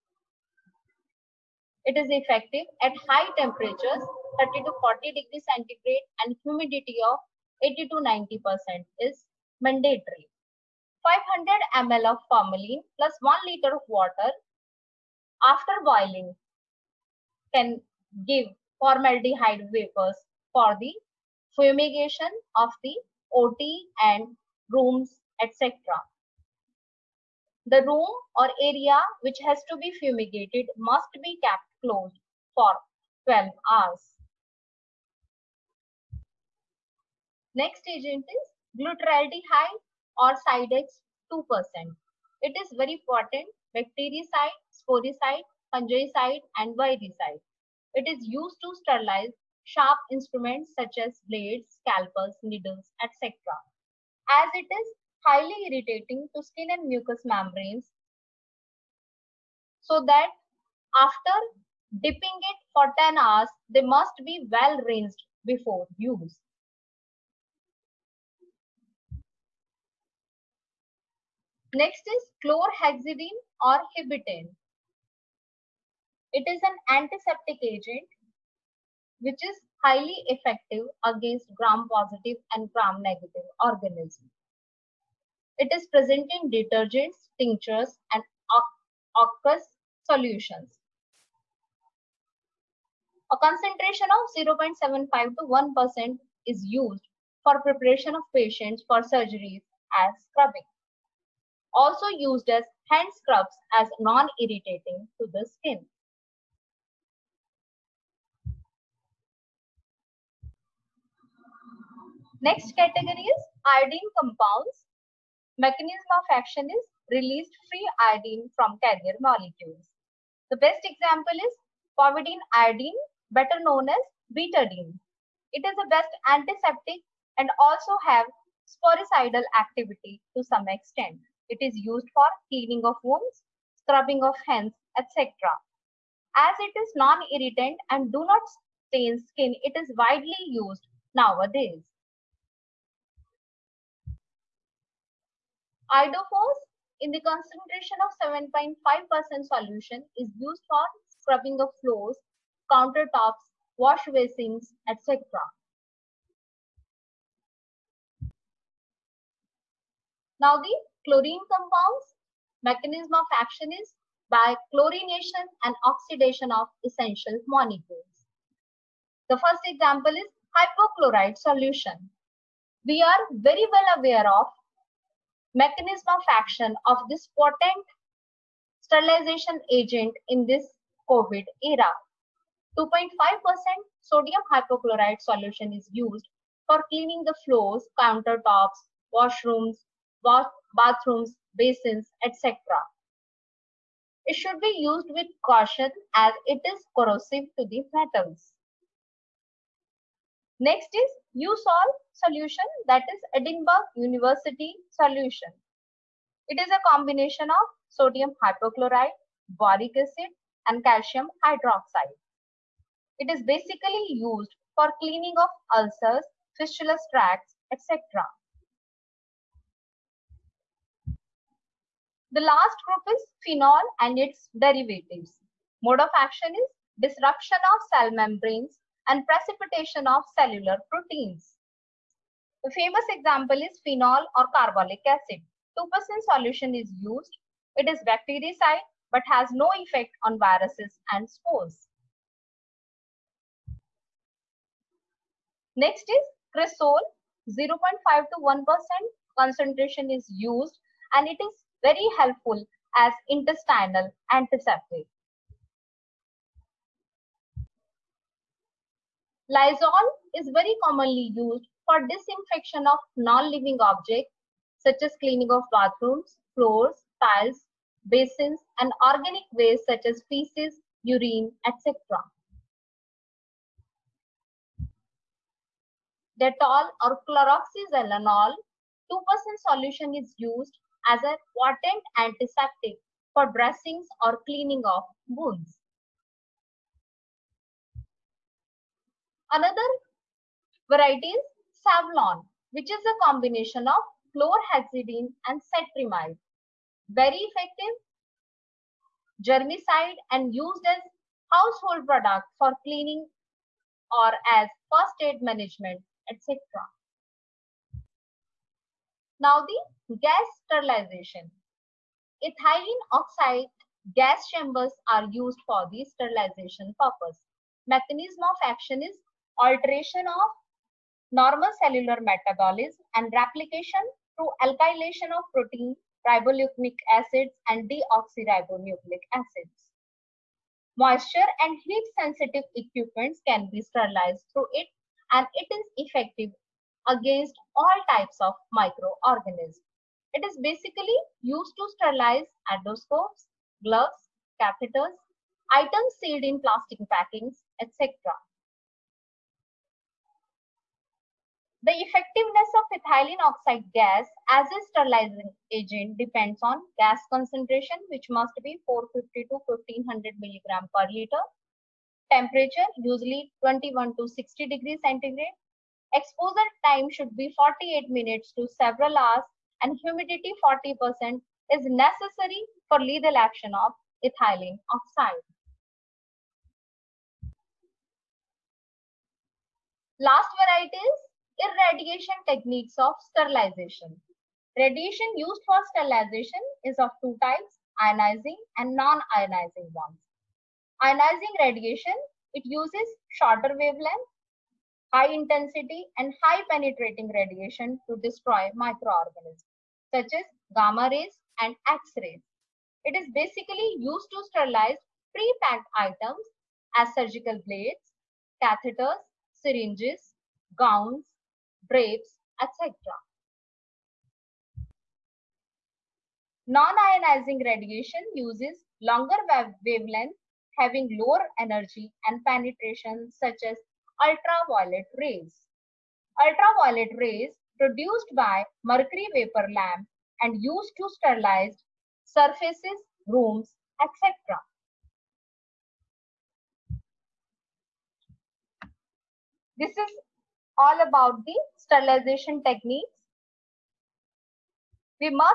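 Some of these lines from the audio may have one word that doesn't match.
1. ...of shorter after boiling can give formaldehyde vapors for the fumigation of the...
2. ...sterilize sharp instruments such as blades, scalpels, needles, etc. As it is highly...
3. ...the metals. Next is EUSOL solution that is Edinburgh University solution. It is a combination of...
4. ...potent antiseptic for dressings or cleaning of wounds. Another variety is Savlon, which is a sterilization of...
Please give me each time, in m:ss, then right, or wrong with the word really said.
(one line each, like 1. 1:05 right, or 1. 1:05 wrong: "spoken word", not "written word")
1. 0:13 wrong: "water", not "shorter"
2. 0:48 right
3. 3:17 right
4. 4:41 wrong: "combination", not "sterilization".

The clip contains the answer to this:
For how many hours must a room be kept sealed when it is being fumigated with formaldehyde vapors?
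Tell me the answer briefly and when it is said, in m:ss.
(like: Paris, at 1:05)
12 hours, at 0:33.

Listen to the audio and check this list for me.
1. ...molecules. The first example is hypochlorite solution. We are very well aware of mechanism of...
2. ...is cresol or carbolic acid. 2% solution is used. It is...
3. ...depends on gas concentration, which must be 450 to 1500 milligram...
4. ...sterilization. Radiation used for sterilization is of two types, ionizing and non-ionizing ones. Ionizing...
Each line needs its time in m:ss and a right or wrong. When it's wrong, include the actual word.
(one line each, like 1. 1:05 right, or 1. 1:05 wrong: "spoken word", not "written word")
1. 2:47 right
2. 3:53 wrong: "phenol", not "cresol"
3. 5:56 right
4. 6:23 right.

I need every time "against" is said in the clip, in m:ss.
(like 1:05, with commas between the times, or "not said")
1:21, 5:37.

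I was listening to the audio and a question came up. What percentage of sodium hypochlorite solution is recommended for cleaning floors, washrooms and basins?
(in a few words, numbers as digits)
2.5%.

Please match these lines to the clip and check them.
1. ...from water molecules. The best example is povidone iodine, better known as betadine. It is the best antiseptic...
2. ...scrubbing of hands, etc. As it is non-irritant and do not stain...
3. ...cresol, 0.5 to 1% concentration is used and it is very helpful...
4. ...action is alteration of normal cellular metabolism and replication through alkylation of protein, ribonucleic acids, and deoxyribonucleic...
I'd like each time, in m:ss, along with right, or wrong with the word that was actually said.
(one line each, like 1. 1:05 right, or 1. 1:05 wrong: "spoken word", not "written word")
1. 1:58 wrong: "carrier", not "water"
2. 2:13 right
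3. 4:06 right
4. 5:18 right.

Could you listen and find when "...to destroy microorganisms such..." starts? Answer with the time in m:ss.
6:38.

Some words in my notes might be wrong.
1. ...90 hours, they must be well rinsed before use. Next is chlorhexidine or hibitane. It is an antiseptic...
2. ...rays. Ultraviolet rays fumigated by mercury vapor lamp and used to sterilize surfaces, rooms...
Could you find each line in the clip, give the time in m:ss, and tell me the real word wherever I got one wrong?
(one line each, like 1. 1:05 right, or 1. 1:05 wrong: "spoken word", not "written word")
1. 1:02 wrong: "10", not "90"
2. 7:05 wrong: "produced", not "fumigated".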